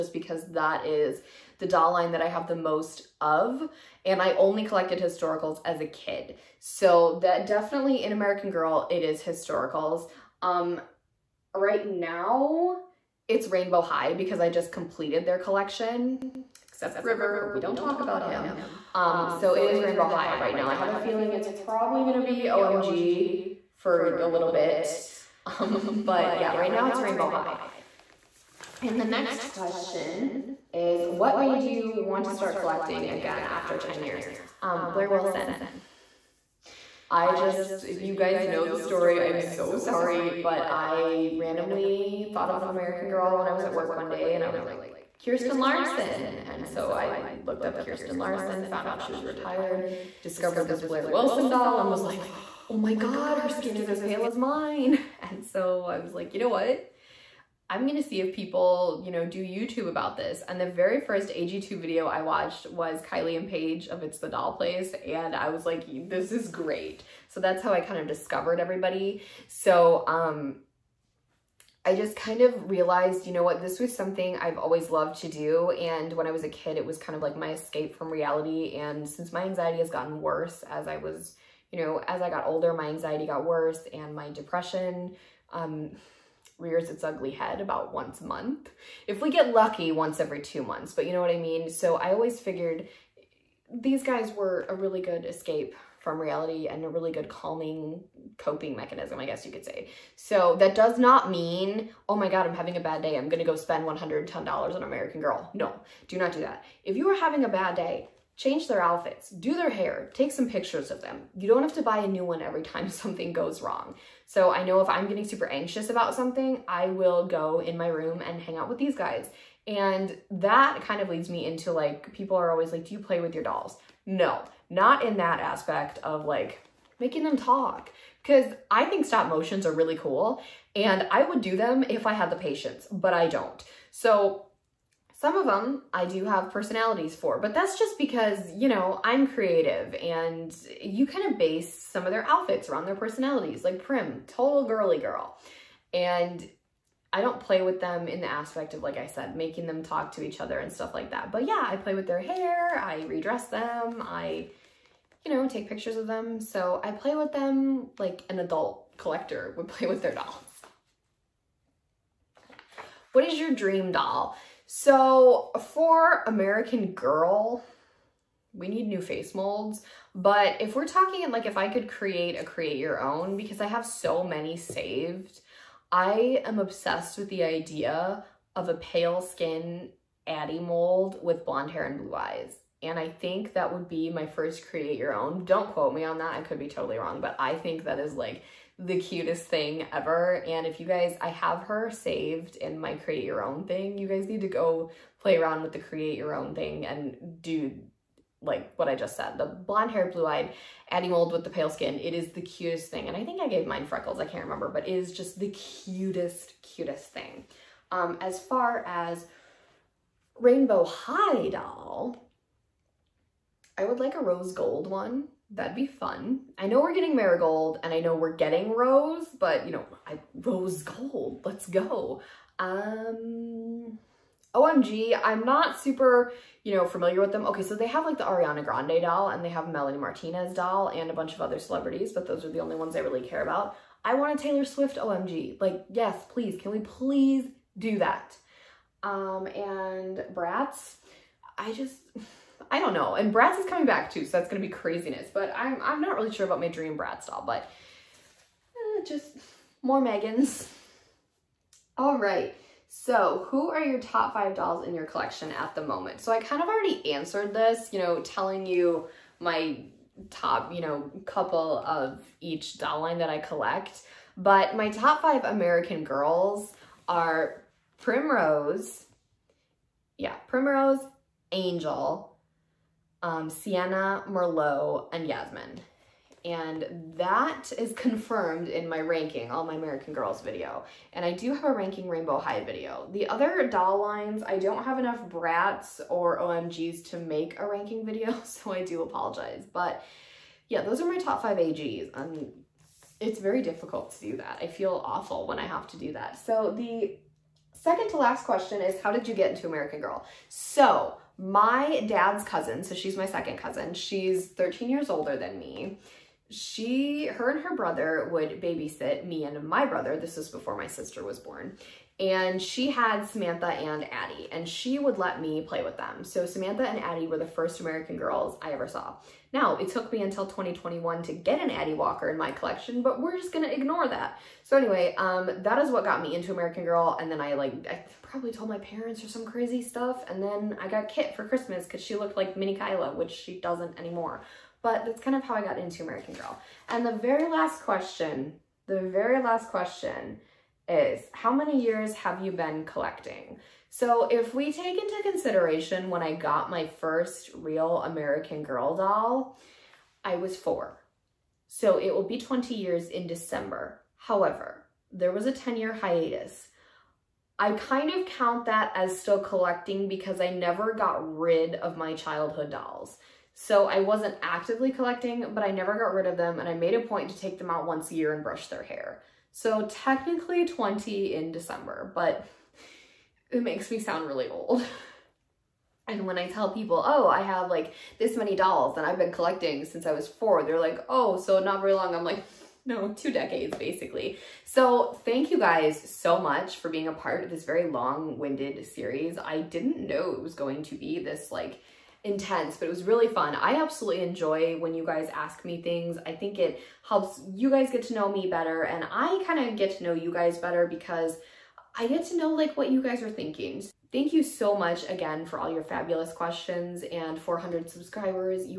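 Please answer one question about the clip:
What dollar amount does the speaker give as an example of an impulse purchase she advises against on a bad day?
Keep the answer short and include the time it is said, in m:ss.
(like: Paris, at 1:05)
$110, at 1:43.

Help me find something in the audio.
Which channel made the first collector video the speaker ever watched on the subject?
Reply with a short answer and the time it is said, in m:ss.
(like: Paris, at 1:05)
It's the Doll Place, at 1:04.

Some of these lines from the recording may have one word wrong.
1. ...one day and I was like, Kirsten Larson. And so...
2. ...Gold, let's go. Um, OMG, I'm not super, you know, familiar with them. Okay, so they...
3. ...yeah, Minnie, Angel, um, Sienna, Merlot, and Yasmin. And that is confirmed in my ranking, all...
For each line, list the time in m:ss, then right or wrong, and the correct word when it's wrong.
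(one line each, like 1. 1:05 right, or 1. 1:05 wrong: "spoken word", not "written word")
1. 0:43 right
2. 3:40 right
3. 4:30 wrong: "Primrose", not "Minnie".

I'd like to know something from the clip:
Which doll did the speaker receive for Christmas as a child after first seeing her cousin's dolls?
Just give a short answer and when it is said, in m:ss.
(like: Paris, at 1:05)
Kit, at 5:31.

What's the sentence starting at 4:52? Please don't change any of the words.
and it's very difficult to do that.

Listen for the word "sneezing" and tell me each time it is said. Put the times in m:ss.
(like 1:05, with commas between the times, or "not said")
not said.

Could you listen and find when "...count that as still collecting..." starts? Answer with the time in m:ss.
5:58.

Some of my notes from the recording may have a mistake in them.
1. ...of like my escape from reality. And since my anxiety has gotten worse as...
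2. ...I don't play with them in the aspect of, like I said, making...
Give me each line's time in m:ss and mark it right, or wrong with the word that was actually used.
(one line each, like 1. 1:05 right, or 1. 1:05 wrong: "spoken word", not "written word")
1. 1:17 right
2. 2:27 right.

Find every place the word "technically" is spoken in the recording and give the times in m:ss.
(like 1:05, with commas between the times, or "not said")
6:09.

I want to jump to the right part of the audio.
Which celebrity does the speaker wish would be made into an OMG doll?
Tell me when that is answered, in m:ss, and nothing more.
3:54.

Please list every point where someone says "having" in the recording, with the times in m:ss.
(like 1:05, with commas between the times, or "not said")
1:42, 1:47.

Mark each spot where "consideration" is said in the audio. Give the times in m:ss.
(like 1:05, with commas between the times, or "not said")
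5:45.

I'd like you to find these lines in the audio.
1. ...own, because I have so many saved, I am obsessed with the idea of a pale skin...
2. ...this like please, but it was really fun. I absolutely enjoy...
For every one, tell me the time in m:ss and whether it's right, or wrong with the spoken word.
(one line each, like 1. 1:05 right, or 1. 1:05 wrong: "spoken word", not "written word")
1. 2:53 right
2. 6:31 wrong: "intense", not "please".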